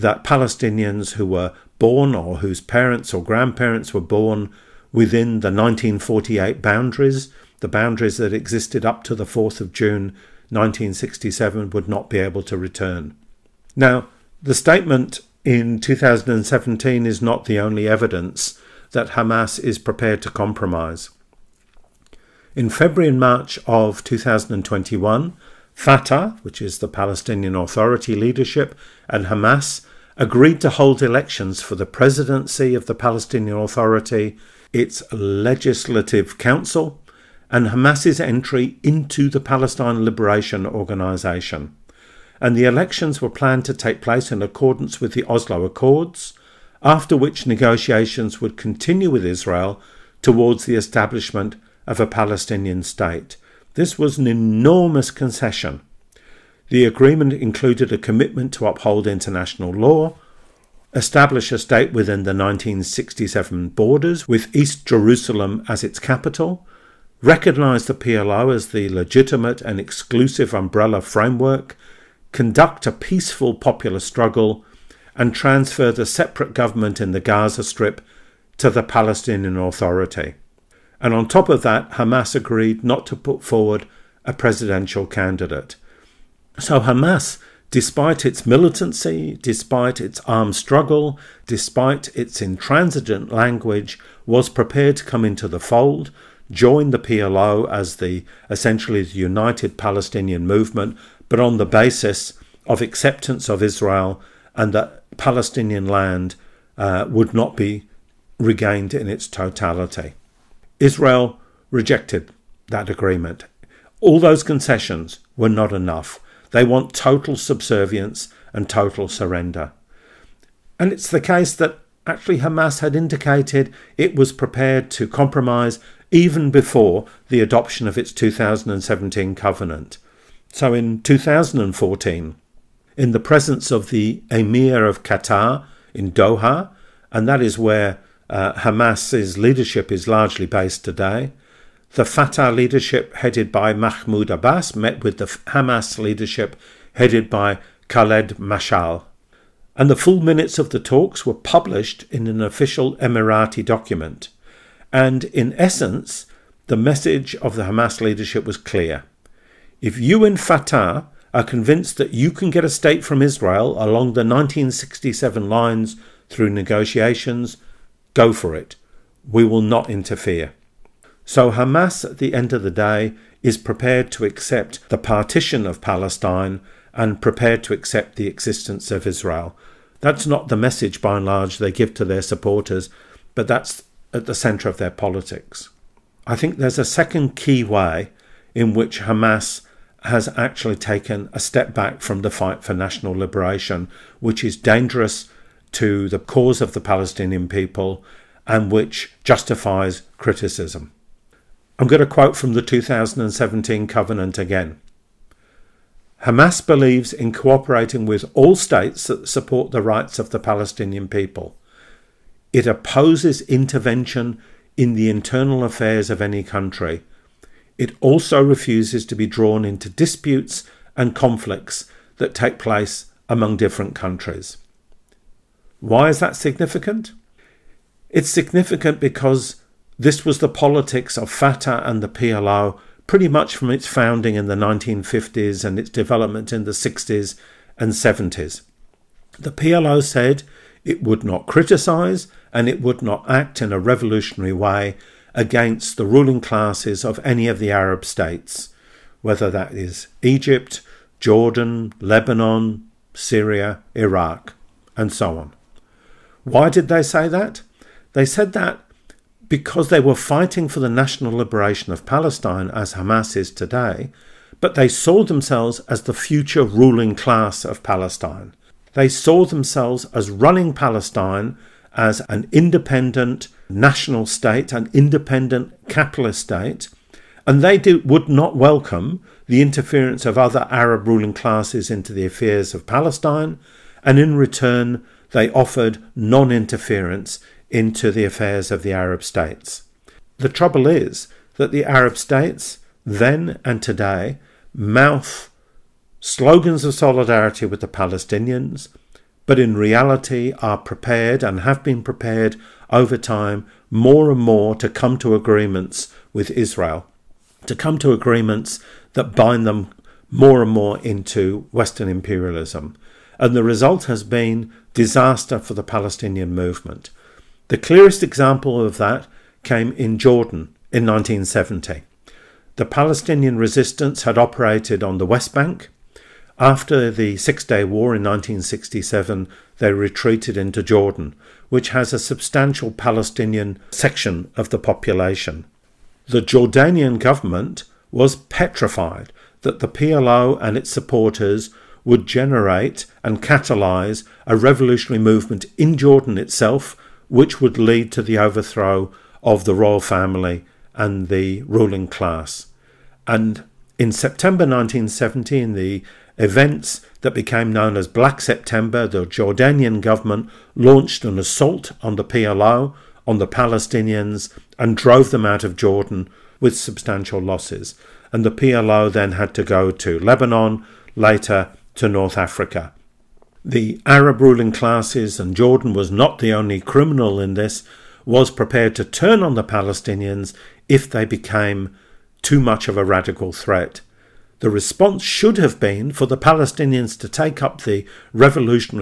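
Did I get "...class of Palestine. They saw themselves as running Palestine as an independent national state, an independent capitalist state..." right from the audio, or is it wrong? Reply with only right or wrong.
right.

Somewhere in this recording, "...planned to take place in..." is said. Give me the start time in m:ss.
0:43.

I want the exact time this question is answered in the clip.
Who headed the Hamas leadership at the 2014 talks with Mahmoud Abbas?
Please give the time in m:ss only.
2:27.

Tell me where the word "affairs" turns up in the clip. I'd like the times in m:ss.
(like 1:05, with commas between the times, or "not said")
3:35, 4:42, 4:48.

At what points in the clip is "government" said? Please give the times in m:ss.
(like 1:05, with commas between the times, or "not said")
1:16, 5:37, 6:00.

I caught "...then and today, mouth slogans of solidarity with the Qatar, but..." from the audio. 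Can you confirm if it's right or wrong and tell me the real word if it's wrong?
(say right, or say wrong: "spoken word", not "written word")
wrong: "Palestinians", not "Qatar".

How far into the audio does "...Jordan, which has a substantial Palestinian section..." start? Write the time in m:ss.
5:30.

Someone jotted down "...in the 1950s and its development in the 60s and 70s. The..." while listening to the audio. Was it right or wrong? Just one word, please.
right.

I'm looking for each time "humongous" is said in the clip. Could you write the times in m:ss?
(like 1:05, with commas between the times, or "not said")
not said.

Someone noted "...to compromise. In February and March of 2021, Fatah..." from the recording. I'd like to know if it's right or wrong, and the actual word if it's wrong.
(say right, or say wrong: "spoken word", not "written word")
right.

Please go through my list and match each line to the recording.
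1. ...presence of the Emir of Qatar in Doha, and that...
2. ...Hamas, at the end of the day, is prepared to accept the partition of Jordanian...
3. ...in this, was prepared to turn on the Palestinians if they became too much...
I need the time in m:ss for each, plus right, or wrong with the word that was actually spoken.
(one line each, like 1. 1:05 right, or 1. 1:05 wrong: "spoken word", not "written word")
1. 2:13 right
2. 2:51 wrong: "Palestine", not "Jordanian"
3. 6:17 right.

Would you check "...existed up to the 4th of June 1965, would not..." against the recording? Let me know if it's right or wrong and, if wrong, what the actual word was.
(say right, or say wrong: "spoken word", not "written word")
wrong: "1967", not "1965".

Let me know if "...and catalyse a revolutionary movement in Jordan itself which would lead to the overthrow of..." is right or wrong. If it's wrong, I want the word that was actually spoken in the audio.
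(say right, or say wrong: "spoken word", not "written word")
right.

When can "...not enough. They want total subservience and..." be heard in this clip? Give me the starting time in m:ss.
1:55.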